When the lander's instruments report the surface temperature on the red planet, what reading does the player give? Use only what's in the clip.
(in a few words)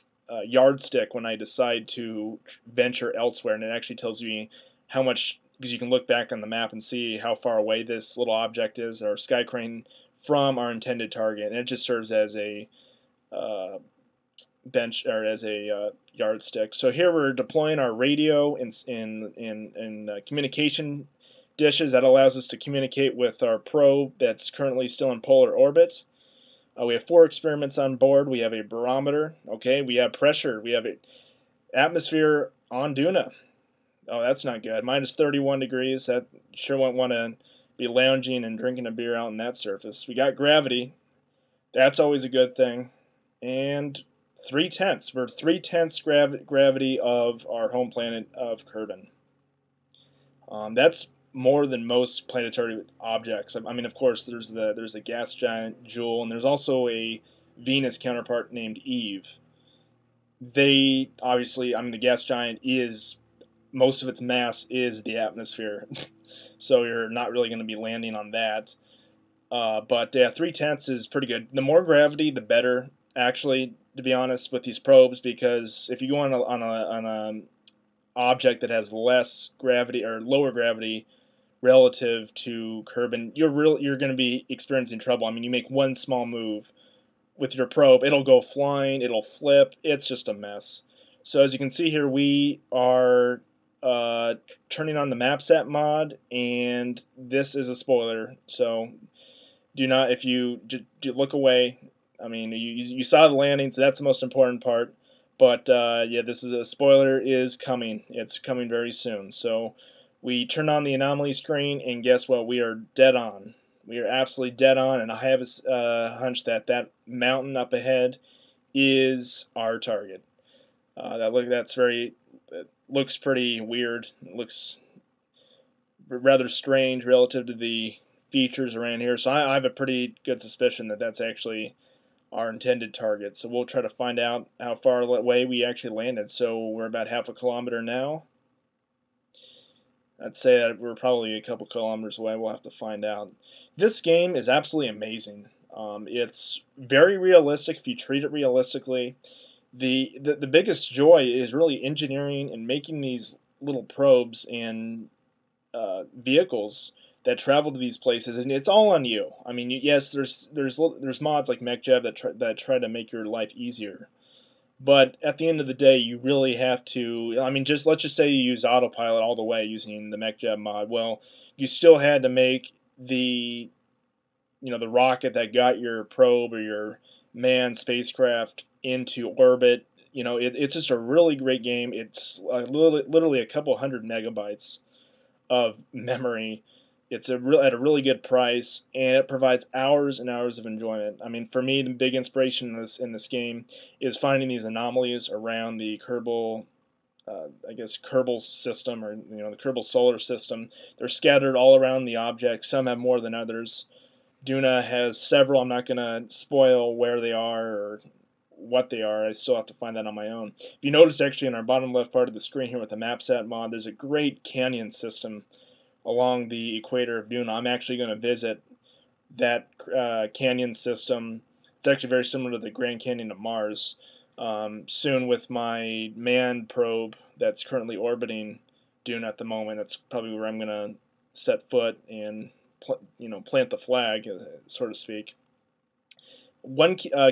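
-31 degrees.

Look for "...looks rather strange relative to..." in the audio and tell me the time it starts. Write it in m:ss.
2:04.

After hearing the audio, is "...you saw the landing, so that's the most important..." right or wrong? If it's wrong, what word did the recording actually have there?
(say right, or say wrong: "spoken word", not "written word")
right.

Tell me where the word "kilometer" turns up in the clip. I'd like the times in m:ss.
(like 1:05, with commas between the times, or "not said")
2:17, 2:21.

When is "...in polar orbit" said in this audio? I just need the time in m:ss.
0:25.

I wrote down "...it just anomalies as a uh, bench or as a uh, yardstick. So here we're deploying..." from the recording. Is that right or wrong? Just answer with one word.
wrong.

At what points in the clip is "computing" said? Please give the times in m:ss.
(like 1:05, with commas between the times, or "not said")
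not said.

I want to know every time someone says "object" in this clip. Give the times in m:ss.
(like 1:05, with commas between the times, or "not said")
0:08, 0:52, 1:18, 3:22.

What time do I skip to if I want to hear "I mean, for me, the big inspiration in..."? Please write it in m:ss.
3:11.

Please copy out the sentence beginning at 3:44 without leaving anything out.
Um, soon with my manned probe that's currently orbiting Duna at the moment.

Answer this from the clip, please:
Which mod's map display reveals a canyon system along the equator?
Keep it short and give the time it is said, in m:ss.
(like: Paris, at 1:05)
MapSat, at 3:32.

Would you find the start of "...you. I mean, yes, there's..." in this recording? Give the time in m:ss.
2:39.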